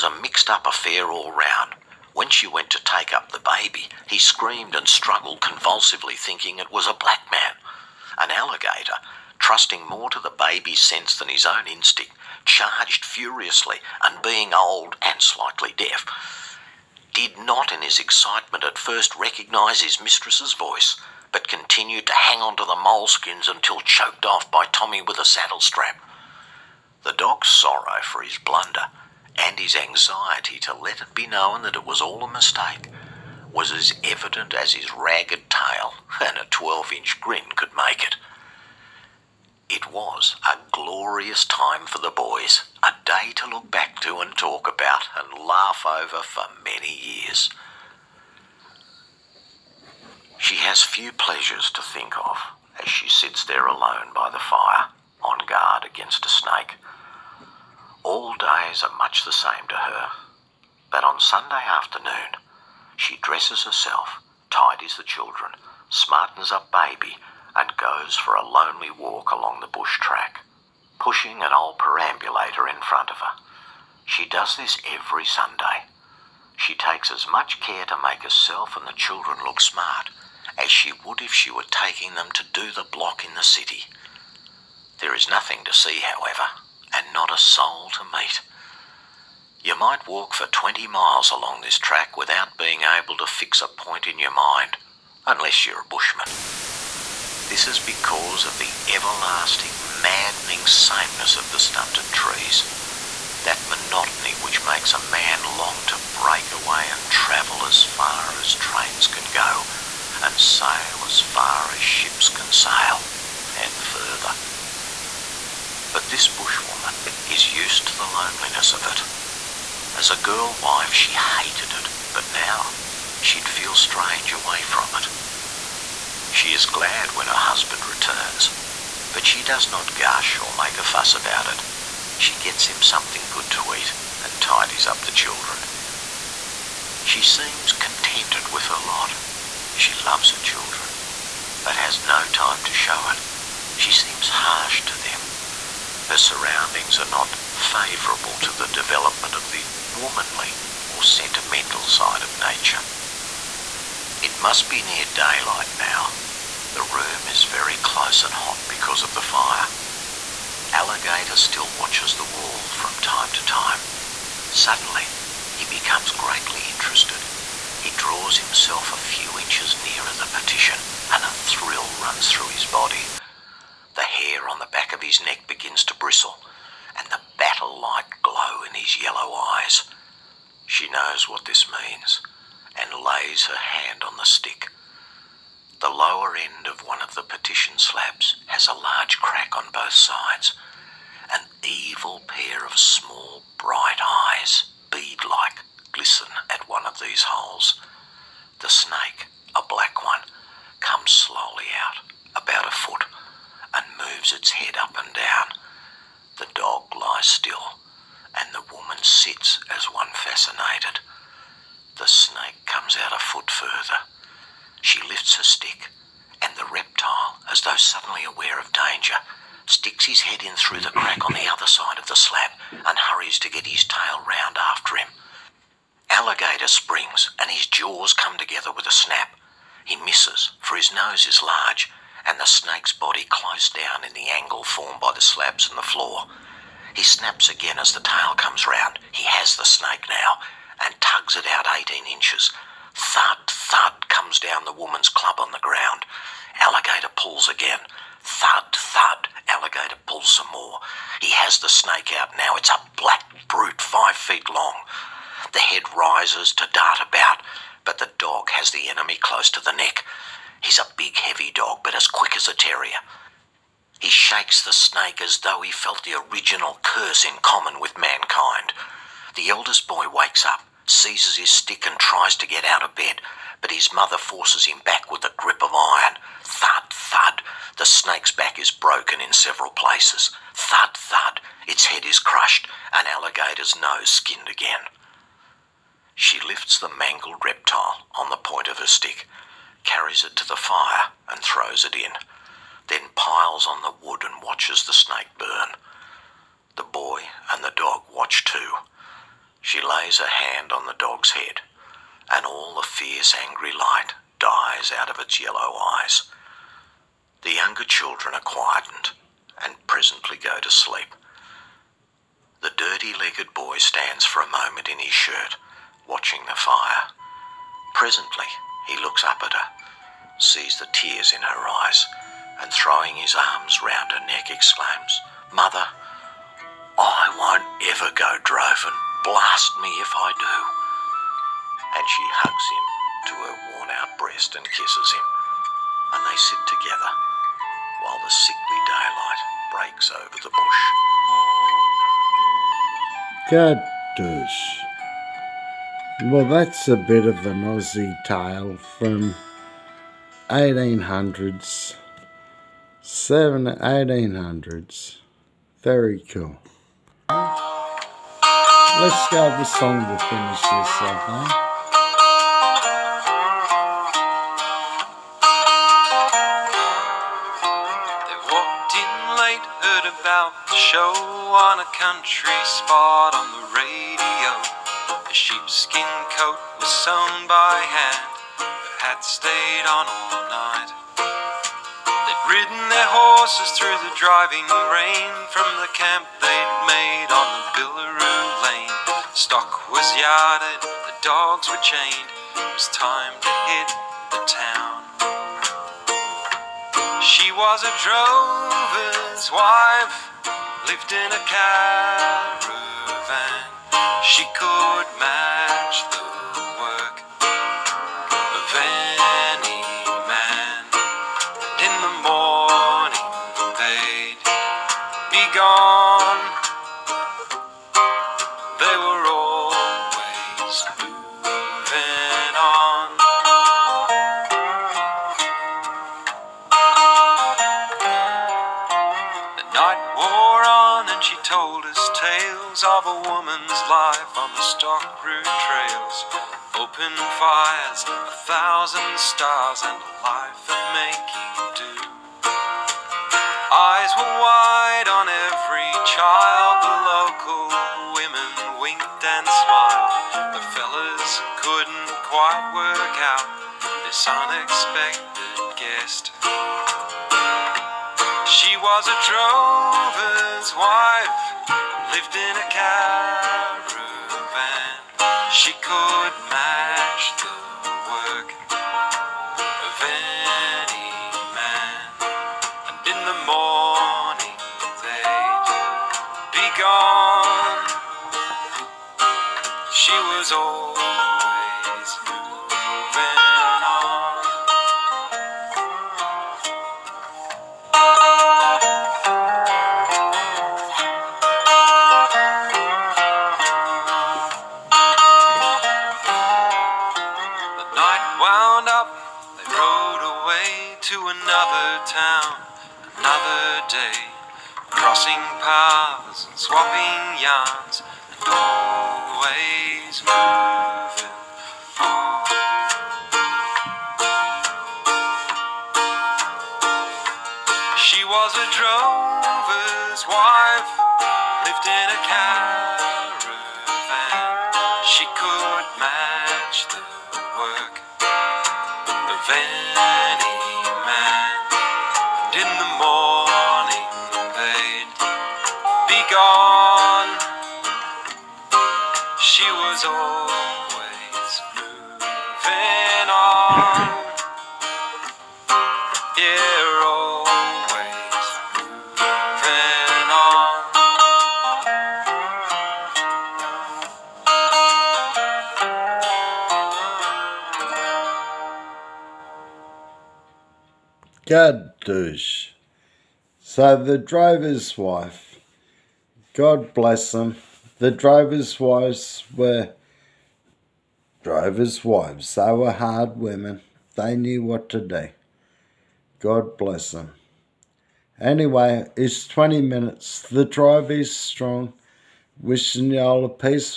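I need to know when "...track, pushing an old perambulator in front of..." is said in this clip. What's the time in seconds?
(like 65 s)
69 s.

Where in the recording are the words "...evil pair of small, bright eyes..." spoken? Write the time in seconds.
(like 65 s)
191 s.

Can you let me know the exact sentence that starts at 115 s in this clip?
But this bushwoman is used to the loneliness of it.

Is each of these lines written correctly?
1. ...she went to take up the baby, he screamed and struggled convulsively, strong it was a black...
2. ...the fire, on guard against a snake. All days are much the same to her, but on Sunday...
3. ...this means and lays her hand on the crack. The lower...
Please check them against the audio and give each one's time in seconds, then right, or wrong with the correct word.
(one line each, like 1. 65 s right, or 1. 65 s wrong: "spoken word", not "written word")
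1. 2 s wrong: "thinking", not "strong"
2. 54 s right
3. 181 s wrong: "stick", not "crack".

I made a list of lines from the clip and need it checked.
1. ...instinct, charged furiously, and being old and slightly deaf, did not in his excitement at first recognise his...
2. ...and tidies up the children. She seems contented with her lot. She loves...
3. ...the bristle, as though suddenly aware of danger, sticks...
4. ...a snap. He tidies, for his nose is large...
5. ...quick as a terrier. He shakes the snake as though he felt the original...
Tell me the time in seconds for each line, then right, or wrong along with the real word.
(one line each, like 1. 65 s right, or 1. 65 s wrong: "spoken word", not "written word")
1. 11 s right
2. 134 s right
3. 216 s wrong: "reptile", not "bristle"
4. 228 s wrong: "misses", not "tidies"
5. 262 s right.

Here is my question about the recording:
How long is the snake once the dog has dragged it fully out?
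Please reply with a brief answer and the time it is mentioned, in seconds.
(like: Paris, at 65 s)
5 feet, at 253 s.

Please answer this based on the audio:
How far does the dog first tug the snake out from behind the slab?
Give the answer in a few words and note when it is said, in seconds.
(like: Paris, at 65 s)
18 inches, at 241 s.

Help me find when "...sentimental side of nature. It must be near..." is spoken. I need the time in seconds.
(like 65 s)
151 s.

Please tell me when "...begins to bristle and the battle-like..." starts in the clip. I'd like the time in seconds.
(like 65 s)
175 s.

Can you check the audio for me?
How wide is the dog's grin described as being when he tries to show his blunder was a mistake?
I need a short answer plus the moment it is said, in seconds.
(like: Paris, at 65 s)
12 inch, at 36 s.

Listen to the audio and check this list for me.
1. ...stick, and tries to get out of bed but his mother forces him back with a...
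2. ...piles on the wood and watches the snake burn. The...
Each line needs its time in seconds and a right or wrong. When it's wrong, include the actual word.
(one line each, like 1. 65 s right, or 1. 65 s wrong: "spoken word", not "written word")
1. 271 s right
2. 293 s right.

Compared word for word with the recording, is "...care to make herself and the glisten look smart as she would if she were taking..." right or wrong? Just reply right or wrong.
wrong.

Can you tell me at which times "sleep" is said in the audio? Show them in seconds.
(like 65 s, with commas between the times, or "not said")
310 s.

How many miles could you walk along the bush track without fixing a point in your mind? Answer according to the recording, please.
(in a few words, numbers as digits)
20 miles.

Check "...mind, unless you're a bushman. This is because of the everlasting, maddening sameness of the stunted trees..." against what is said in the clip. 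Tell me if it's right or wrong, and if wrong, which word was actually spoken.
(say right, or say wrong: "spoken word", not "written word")
right.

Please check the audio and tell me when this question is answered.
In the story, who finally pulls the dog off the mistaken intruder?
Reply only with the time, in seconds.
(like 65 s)
24 s.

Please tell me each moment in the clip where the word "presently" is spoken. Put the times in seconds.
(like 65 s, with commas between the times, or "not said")
309 s, 317 s.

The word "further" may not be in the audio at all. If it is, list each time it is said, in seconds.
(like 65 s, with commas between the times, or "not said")
113 s, 213 s.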